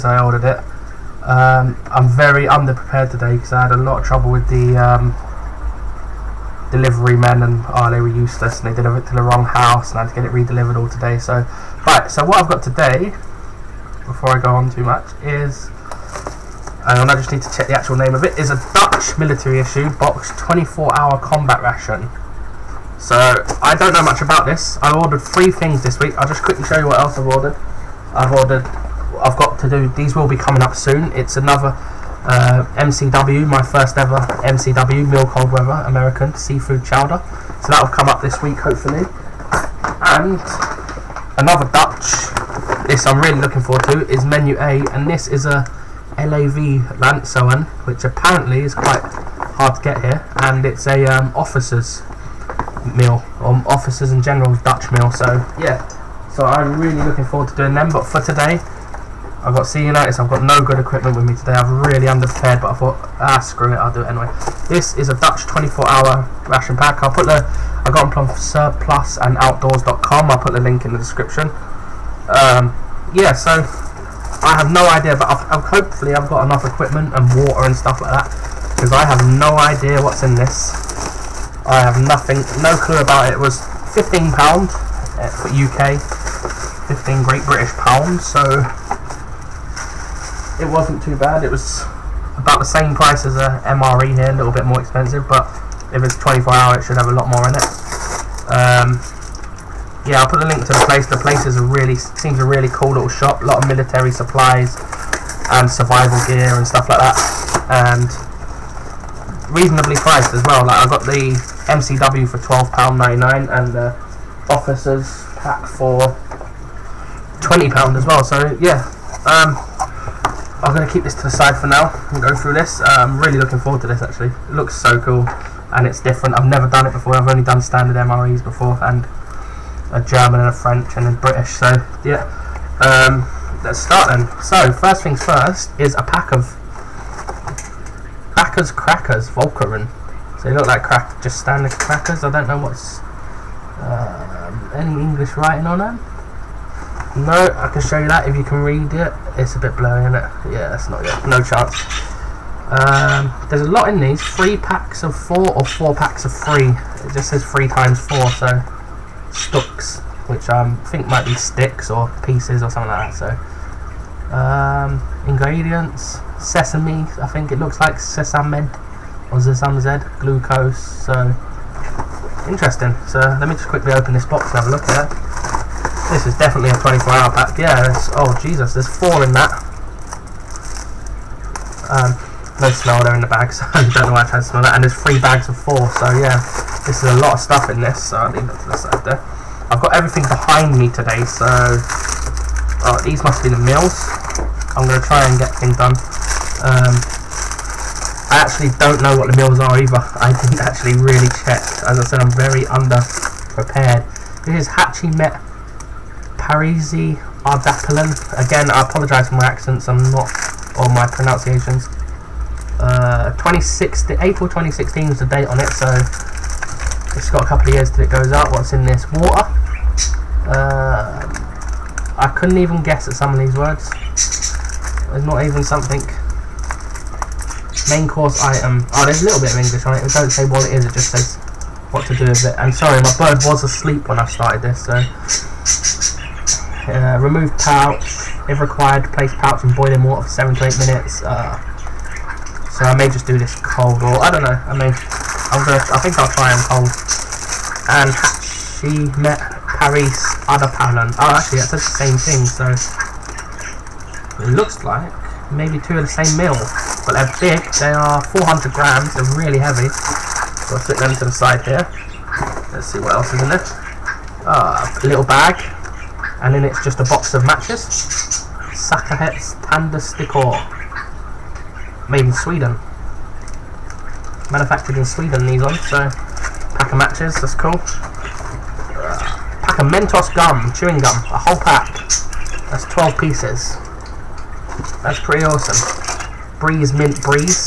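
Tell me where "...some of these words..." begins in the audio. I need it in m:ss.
3:43.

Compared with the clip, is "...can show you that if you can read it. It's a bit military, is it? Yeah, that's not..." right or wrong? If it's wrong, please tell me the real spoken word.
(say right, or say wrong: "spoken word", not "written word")
wrong: "blurry", not "military".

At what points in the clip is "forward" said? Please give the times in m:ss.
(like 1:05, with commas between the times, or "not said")
0:43, 0:57, 2:03.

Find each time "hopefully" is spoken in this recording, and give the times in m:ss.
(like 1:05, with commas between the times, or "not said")
0:38, 1:15.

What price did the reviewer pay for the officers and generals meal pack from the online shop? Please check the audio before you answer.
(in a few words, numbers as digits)
£20.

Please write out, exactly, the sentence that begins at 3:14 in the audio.
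I'm going to try and get things done.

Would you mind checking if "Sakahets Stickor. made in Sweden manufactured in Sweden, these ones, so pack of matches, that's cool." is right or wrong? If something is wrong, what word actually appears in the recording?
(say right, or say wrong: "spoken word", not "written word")
right.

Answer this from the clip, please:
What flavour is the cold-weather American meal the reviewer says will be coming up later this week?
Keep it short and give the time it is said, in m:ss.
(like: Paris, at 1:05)
Seafood chowder, at 0:36.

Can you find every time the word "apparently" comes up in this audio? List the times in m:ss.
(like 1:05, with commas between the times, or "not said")
0:48.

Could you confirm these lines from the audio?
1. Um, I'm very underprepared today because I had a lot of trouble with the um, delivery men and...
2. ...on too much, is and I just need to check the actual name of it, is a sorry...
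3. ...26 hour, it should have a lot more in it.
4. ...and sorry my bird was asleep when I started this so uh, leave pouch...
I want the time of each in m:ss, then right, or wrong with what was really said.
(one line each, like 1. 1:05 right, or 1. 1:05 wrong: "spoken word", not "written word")
1. 0:01 right
2. 0:14 wrong: "military", not "sorry"
3. 1:36 wrong: "24", not "26"
4. 3:52 wrong: "remove", not "leave".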